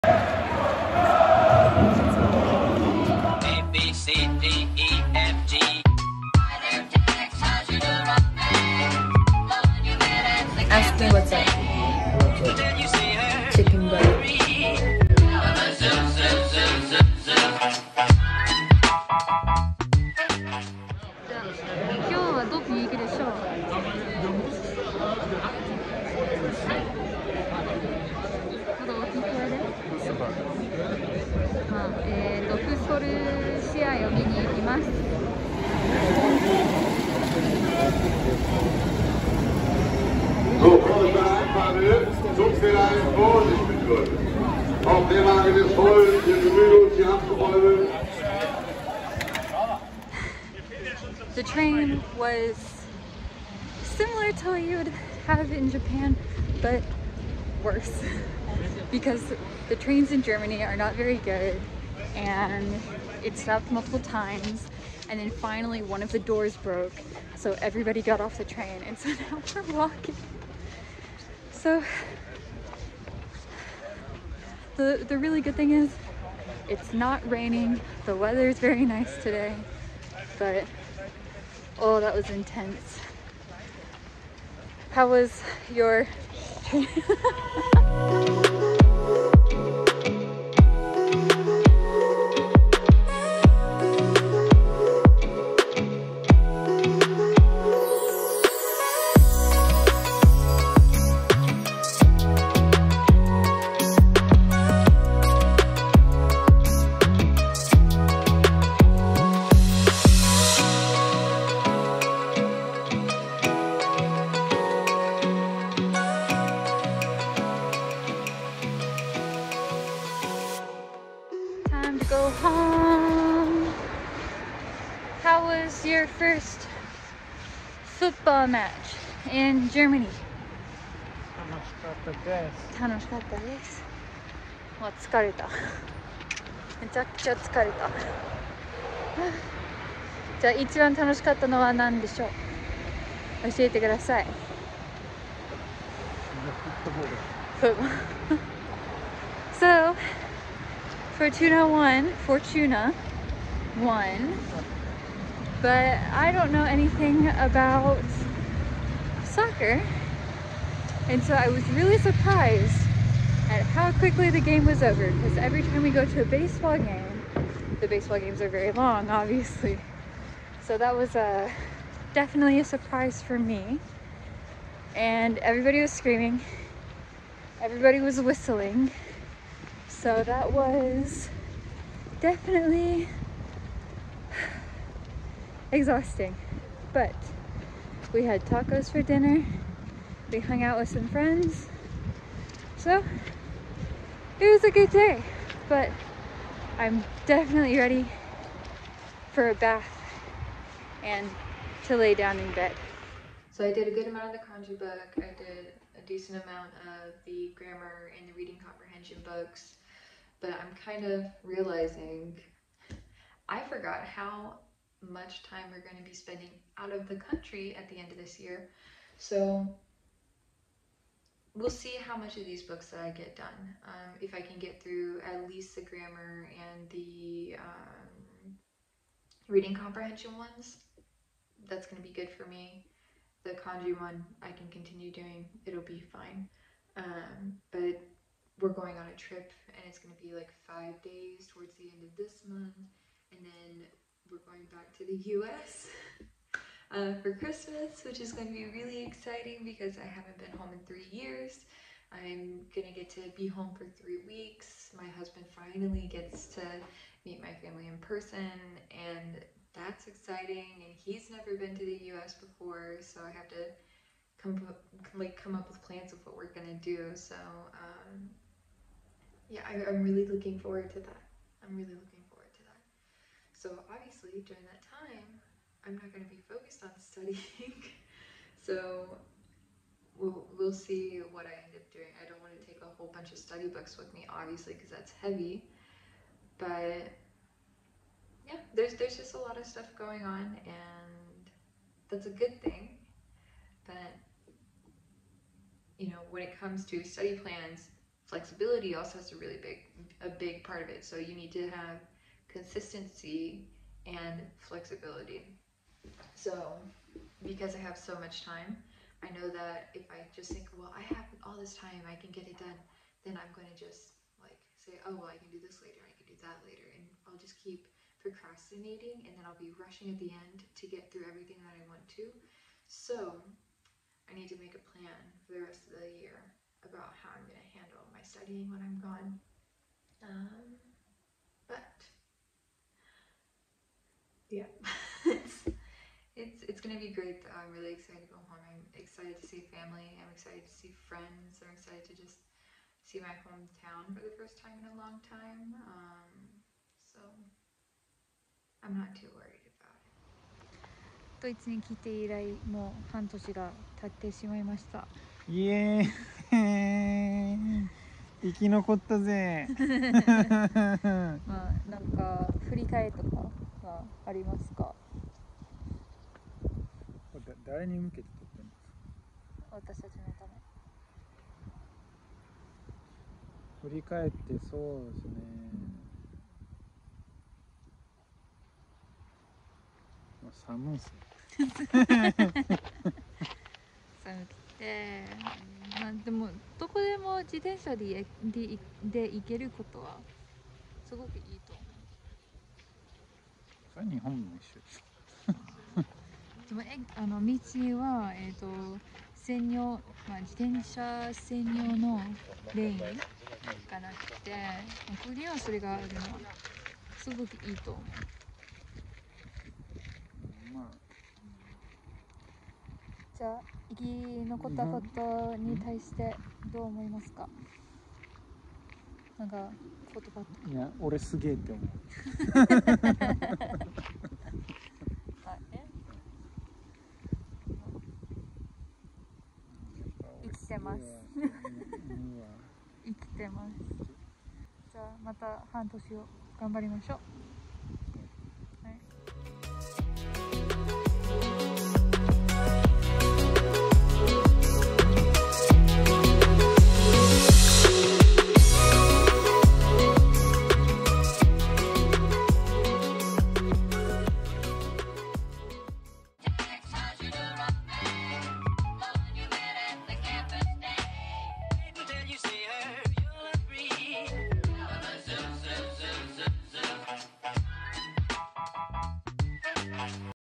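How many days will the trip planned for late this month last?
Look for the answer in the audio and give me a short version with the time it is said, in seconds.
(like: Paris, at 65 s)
5, at 240 s.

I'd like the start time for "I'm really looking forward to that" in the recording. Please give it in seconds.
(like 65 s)
271 s.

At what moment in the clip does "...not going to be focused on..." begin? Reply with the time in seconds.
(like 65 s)
275 s.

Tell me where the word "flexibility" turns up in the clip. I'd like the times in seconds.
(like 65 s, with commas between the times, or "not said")
298 s, 304 s.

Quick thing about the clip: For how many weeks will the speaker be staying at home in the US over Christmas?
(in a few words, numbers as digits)
3.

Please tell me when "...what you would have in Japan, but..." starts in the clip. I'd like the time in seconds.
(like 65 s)
54 s.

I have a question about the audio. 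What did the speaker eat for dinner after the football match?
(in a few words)
tacos.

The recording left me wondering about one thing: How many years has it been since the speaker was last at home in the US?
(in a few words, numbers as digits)
3 years.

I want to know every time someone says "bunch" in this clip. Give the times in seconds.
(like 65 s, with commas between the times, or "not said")
283 s.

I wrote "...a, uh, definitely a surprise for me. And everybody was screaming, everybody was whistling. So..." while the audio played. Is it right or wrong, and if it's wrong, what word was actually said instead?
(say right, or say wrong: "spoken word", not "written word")
right.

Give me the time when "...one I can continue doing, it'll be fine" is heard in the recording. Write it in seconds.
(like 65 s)
233 s.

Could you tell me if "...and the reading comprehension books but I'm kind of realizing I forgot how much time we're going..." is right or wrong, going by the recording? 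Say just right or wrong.
right.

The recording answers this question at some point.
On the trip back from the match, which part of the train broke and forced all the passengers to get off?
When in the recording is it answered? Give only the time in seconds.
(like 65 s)
65 s.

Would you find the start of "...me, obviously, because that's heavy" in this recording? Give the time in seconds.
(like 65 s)
284 s.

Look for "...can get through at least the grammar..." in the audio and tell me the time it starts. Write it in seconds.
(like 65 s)
224 s.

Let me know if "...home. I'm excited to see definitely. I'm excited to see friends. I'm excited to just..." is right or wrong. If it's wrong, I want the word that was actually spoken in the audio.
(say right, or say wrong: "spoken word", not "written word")
wrong: "family", not "definitely".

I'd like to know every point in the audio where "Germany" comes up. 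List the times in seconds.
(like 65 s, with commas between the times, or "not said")
60 s, 129 s.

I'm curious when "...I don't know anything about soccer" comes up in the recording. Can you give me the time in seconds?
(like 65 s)
156 s.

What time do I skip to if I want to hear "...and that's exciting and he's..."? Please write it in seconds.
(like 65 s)
258 s.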